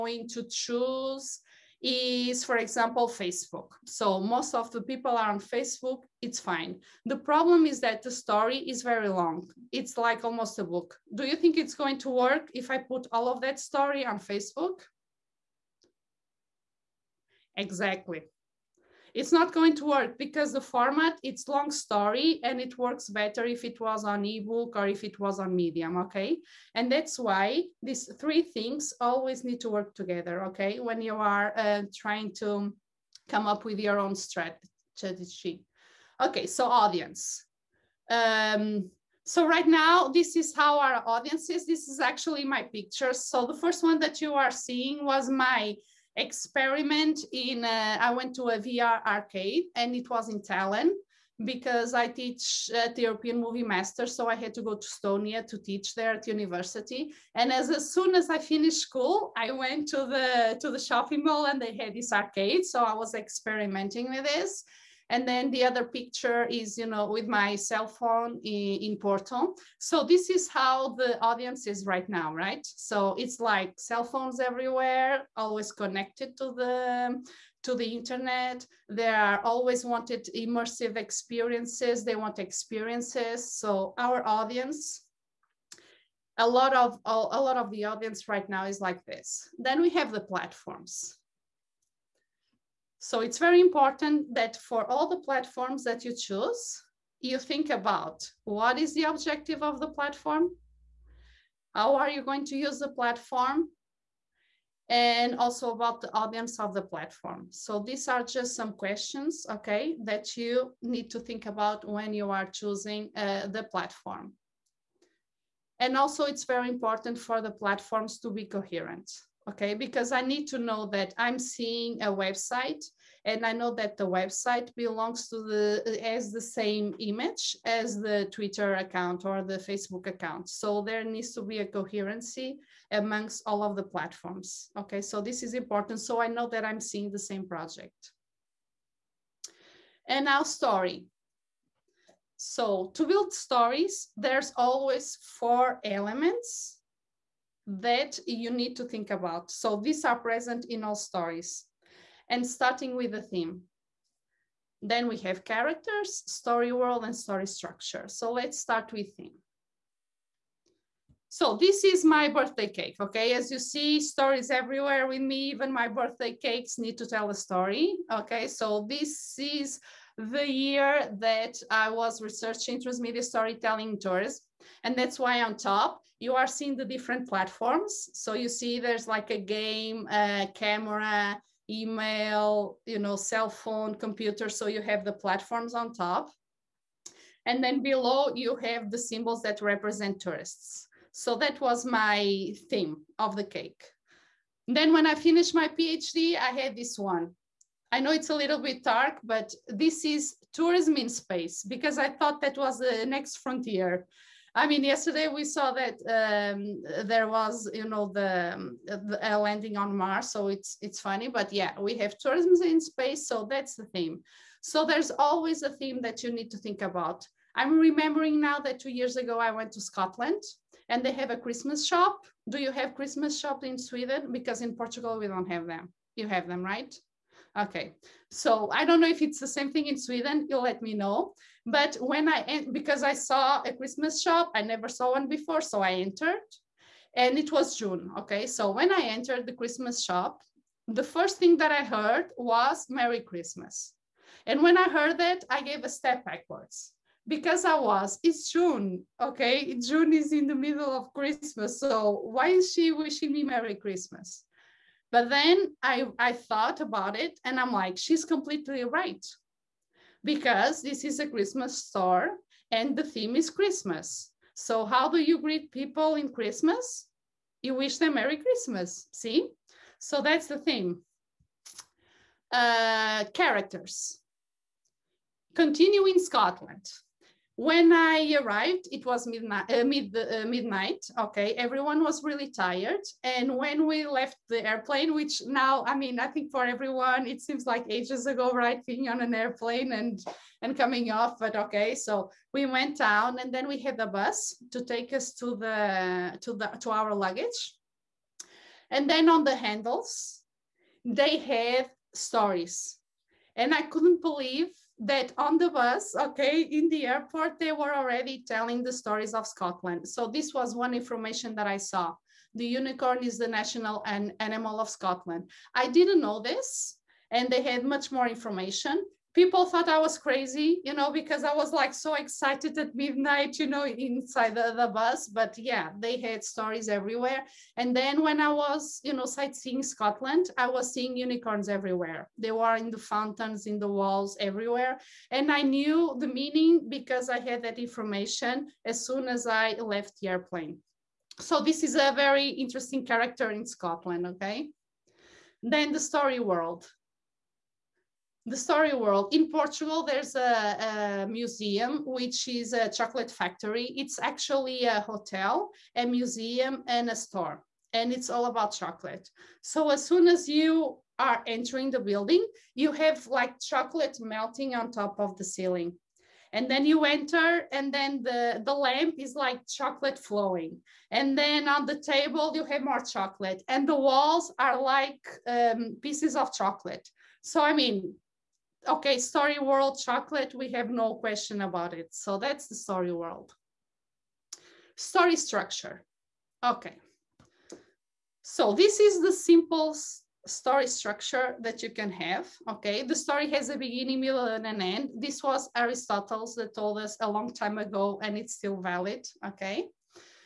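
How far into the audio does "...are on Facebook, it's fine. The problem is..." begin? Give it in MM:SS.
00:05.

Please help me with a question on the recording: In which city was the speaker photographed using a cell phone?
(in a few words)
Porto.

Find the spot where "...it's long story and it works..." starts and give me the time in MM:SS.
00:21.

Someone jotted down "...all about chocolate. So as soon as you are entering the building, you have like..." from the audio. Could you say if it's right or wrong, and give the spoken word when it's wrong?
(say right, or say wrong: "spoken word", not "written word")
right.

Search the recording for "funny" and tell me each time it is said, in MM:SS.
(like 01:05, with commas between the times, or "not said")
03:30.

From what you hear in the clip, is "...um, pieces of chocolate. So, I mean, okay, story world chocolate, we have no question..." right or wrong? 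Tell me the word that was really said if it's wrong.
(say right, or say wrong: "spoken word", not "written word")
right.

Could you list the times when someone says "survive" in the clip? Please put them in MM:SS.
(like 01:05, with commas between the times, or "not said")
not said.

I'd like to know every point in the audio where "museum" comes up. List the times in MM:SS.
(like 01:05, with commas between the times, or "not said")
05:51, 05:56.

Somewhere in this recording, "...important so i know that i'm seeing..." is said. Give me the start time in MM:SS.
02:15.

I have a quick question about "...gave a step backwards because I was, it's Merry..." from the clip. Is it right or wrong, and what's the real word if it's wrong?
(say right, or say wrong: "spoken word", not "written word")
wrong: "June", not "Merry".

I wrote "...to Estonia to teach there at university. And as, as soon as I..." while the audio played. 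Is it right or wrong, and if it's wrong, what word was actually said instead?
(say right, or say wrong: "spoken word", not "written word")
right.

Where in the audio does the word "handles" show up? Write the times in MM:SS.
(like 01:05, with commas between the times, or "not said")
04:59.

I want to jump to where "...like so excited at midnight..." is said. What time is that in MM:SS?
05:21.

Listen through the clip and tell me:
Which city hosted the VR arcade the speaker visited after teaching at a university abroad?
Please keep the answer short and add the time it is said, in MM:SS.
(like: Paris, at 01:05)
Tallinn, at 00:50.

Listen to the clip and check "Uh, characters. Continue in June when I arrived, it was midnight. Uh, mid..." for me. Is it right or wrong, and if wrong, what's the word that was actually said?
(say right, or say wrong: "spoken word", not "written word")
wrong: "Scotland", not "June".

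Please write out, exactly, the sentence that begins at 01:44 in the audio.
And also about the audience of the platform.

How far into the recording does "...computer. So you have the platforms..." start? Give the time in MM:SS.
03:03.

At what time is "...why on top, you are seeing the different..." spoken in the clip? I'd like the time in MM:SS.
02:55.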